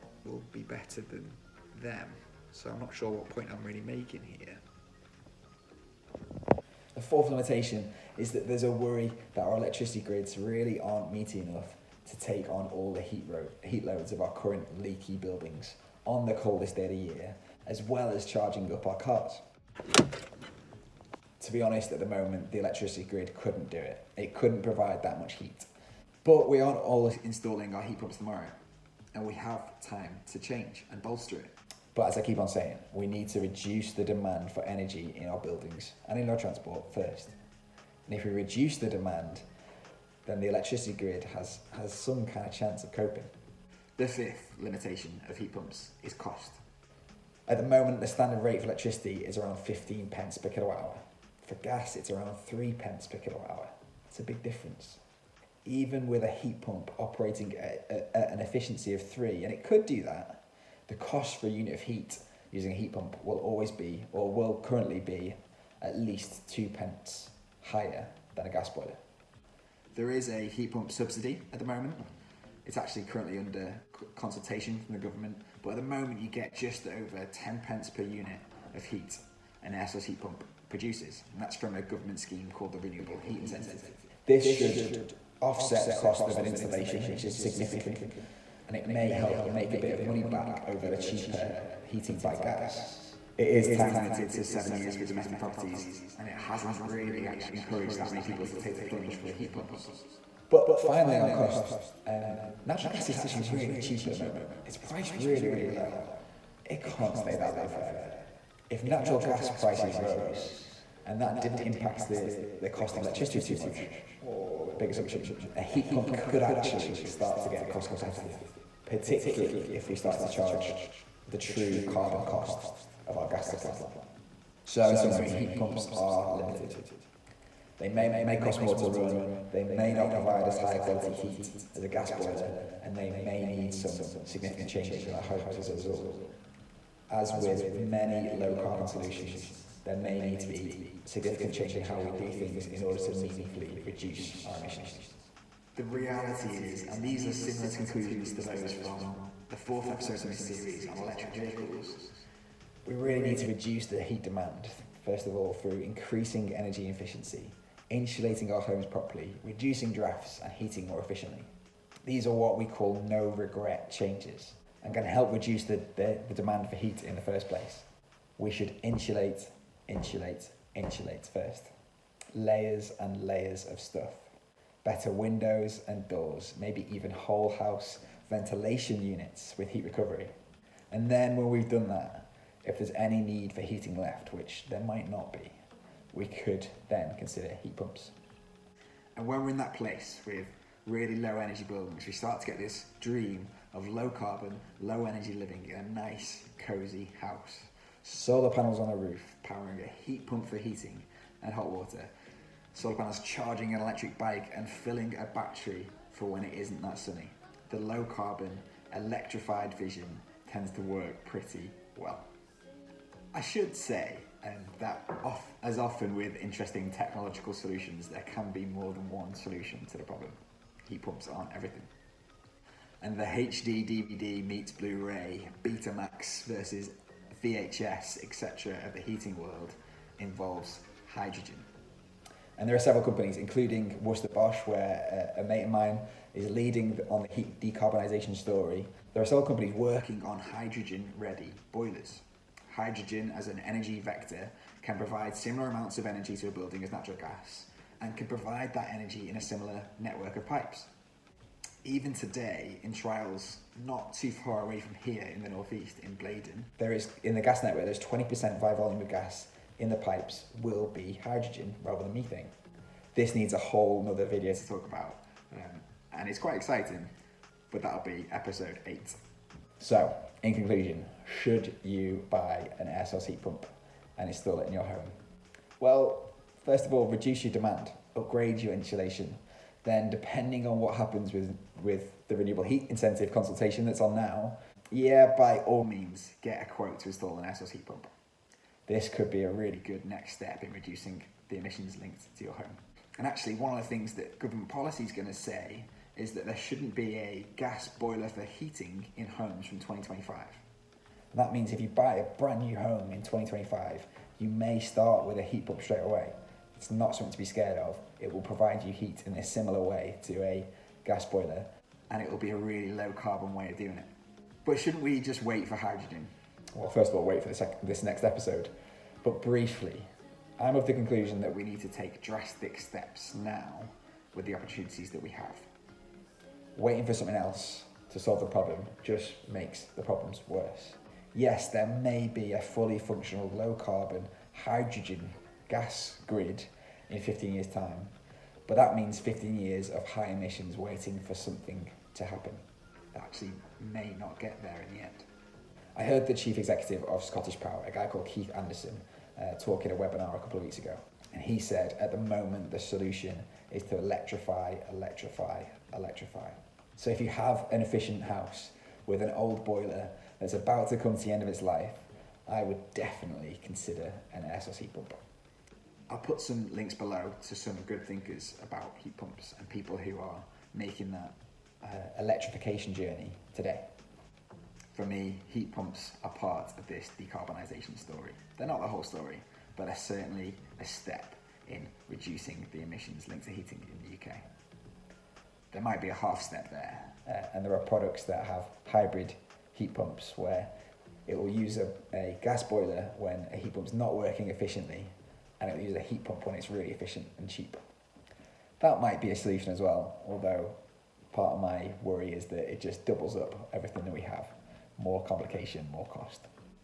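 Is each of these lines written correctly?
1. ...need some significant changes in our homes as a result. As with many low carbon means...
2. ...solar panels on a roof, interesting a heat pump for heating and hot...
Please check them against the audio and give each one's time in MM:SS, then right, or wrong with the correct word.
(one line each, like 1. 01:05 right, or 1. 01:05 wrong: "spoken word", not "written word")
1. 02:13 wrong: "solutions", not "means"
2. 03:18 wrong: "powering", not "interesting".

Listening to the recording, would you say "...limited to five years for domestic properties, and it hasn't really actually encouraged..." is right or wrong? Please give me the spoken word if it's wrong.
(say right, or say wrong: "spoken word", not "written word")
wrong: "seven", not "five".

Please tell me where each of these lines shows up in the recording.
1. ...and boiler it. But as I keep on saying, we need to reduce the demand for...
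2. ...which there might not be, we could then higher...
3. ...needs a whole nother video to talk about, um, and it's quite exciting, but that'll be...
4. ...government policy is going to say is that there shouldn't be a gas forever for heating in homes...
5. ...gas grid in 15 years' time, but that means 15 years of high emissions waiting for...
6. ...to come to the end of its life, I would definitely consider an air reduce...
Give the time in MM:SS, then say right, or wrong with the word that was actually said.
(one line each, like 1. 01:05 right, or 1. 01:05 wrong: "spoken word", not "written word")
1. 00:30 wrong: "bolster", not "boiler"
2. 03:04 wrong: "consider", not "higher"
3. 04:23 right
4. 04:54 wrong: "boiler", not "forever"
5. 05:35 right
6. 06:00 wrong: "source", not "reduce".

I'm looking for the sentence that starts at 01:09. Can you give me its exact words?
There is a heat pump subsidy at the moment.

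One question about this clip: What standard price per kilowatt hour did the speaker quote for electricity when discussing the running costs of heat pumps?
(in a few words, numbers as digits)
15 pence.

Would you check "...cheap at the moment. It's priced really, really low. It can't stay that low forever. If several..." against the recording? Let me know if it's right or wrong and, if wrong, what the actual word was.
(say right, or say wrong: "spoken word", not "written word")
wrong: "natural", not "several".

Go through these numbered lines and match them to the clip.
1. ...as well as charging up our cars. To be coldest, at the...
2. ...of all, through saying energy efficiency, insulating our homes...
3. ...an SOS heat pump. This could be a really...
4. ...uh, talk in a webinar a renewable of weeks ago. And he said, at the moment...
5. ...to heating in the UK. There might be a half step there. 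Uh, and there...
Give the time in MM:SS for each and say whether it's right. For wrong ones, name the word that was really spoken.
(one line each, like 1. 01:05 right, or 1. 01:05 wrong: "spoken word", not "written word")
1. 00:17 wrong: "honest", not "coldest"
2. 02:35 wrong: "increasing", not "saying"
3. 04:47 right
4. 05:49 wrong: "couple", not "renewable"
5. 06:23 right.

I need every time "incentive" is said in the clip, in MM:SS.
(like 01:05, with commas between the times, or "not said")
01:23, 04:42.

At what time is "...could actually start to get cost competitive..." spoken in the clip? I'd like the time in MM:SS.
01:56.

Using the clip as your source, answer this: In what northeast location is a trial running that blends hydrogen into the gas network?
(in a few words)
Blaydon.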